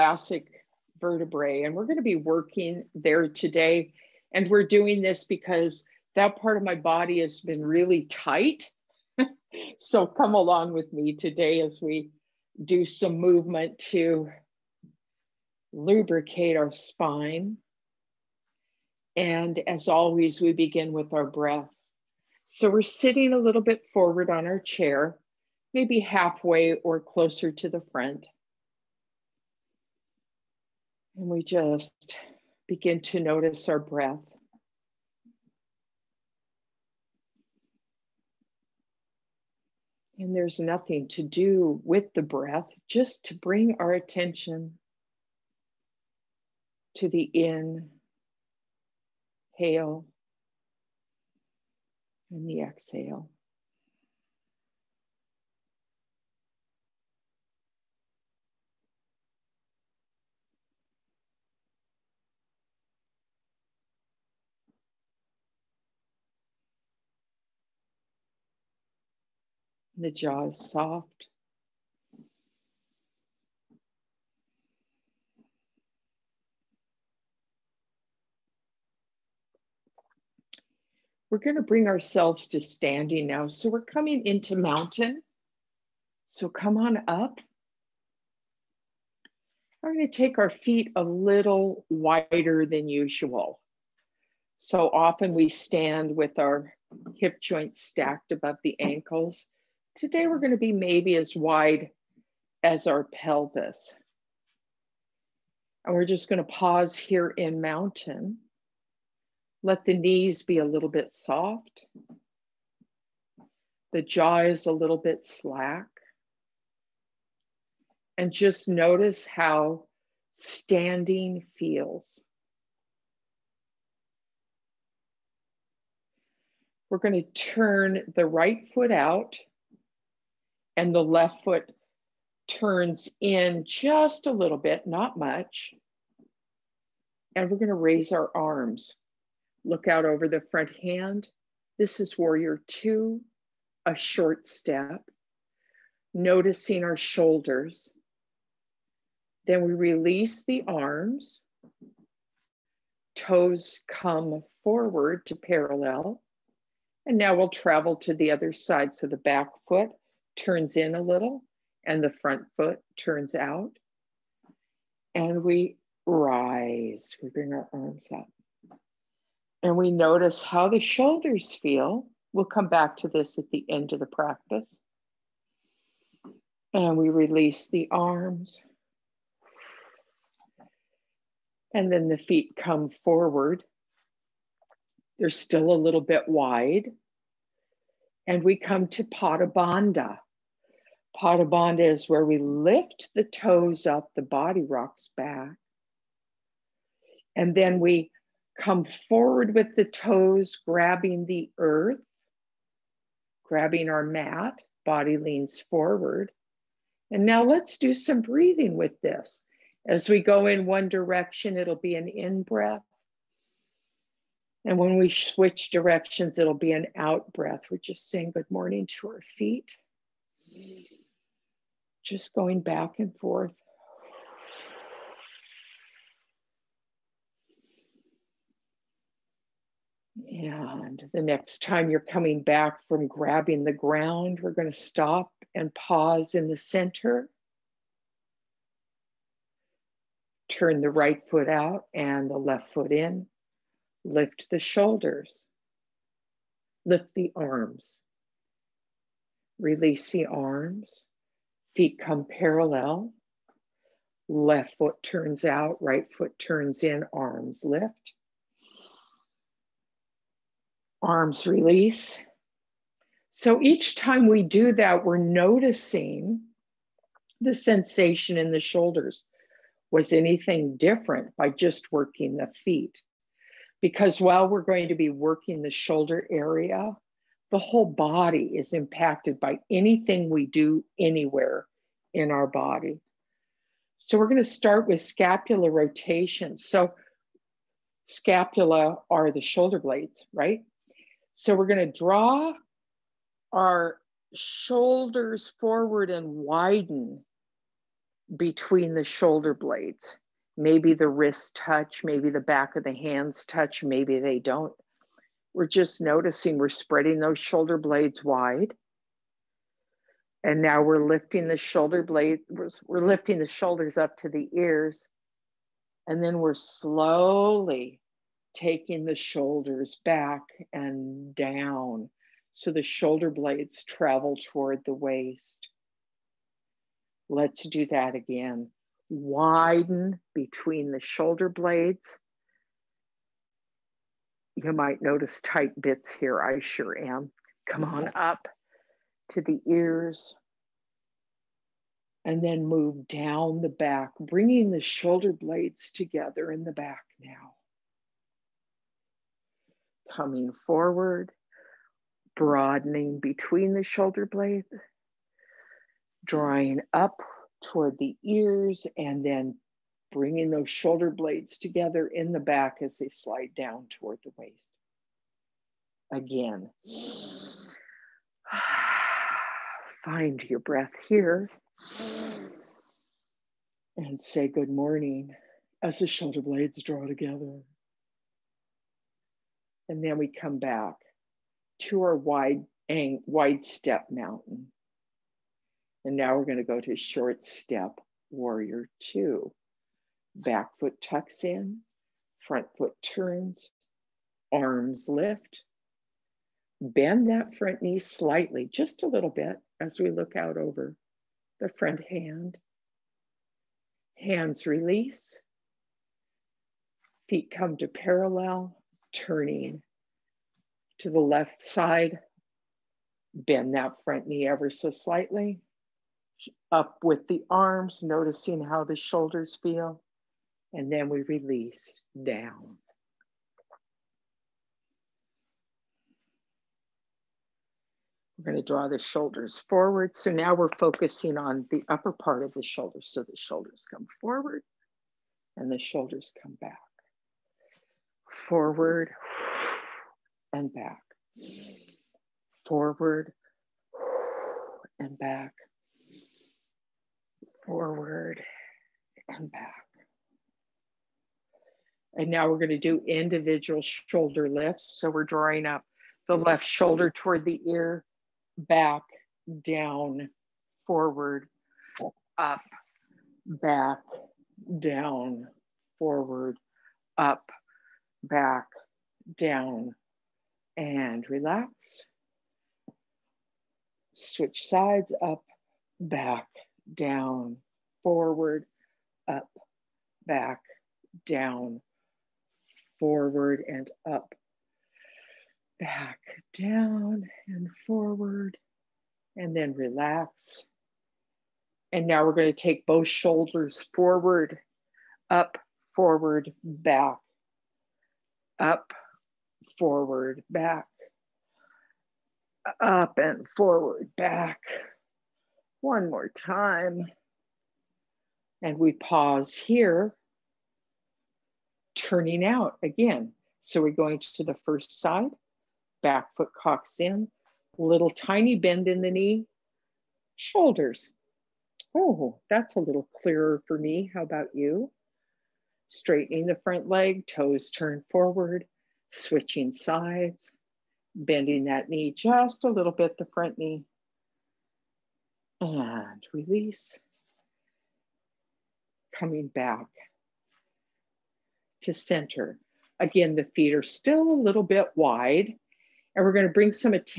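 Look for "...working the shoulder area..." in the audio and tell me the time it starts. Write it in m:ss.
4:35.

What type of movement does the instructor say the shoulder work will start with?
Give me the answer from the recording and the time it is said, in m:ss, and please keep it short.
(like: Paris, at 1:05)
Scapular rotation, at 4:45.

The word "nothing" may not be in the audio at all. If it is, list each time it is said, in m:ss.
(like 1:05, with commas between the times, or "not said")
0:40.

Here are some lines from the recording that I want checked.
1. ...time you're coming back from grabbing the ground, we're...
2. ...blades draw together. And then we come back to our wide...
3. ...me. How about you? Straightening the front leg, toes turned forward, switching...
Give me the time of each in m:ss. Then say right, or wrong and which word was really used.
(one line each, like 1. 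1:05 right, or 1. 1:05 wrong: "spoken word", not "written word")
1. 3:51 right
2. 6:16 right
3. 8:43 right.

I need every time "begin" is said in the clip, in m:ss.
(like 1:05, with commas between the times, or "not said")
0:20, 0:32.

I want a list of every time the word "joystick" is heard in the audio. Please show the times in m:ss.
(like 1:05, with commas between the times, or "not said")
not said.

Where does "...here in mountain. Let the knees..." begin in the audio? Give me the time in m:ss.
1:46.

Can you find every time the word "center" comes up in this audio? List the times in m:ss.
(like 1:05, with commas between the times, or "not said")
3:56, 9:01.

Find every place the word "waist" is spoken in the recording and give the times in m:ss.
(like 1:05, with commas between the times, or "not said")
5:24, 6:04.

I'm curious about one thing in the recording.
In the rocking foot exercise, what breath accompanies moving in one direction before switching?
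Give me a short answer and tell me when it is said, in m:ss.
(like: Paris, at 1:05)
An in breath, at 3:31.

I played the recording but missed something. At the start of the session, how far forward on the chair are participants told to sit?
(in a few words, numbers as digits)
Halfway or closer to the front.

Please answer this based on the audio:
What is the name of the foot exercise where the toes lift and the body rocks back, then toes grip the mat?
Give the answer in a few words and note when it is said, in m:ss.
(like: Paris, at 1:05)
Pada Bandha, at 3:09.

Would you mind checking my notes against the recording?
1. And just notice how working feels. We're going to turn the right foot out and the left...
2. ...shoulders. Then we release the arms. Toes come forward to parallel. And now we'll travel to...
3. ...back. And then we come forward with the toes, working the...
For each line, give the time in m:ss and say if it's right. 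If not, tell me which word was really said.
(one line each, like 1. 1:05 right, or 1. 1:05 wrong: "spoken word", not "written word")
1. 1:58 wrong: "standing", not "working"
2. 2:26 right
3. 3:15 wrong: "grabbing", not "working".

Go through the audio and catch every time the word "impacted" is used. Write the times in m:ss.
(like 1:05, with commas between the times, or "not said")
4:38.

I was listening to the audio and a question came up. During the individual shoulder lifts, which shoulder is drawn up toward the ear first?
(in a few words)
The left shoulder.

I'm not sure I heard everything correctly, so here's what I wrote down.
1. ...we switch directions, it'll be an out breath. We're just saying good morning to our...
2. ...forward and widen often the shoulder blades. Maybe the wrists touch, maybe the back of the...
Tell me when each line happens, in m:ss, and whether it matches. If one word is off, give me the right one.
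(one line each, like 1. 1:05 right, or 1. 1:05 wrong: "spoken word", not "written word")
1. 3:34 right
2. 4:55 wrong: "between", not "often".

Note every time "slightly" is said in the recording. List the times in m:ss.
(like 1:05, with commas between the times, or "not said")
6:37, 6:54.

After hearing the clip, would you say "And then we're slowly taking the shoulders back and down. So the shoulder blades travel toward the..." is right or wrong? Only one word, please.
right.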